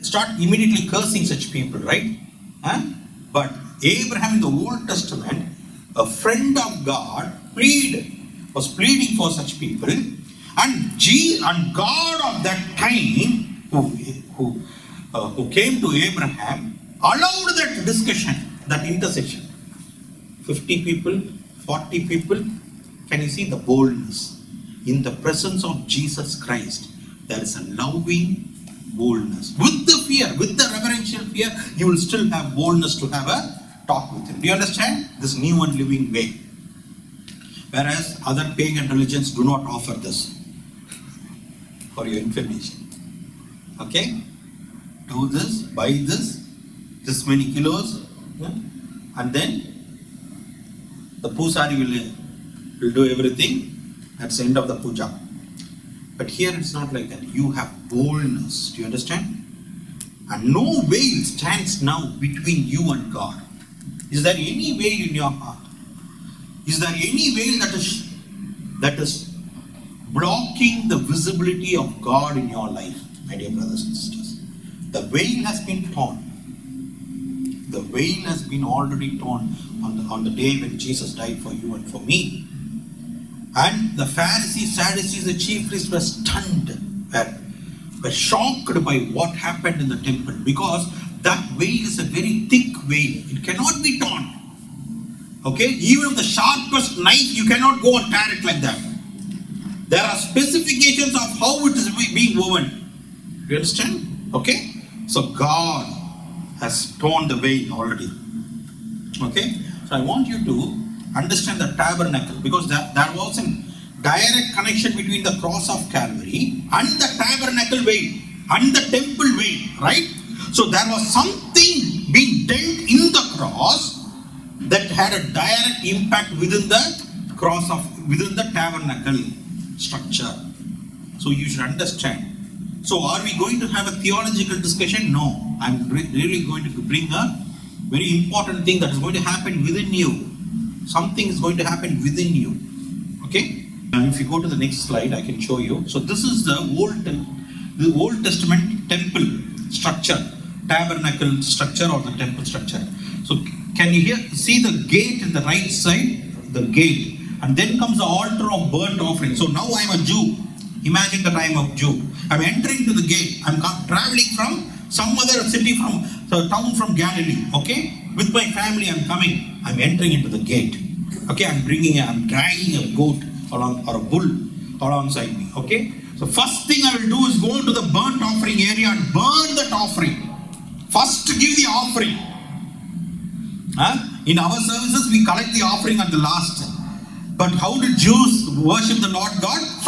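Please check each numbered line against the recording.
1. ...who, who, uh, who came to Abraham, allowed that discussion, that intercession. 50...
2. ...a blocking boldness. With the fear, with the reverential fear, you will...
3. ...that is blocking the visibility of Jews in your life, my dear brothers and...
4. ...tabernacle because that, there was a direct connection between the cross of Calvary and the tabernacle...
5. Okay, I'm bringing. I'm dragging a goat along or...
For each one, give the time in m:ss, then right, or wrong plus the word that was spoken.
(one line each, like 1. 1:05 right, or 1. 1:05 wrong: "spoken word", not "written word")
1. 0:13 right
2. 0:27 wrong: "loving", not "blocking"
3. 1:08 wrong: "God", not "Jews"
4. 1:51 right
5. 2:51 right.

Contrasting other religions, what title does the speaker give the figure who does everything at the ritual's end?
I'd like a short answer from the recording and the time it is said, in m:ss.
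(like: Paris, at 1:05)
pusari, at 0:51.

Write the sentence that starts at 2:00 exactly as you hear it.
So there was something being dealt in the cross that had a direct impact within the cross of within the tabernacle structure.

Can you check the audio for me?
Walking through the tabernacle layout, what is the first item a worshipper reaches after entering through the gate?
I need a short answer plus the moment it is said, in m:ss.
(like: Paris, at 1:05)
altar of burnt offering, at 2:38.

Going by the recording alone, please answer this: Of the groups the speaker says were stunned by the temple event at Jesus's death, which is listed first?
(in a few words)
Pharisees.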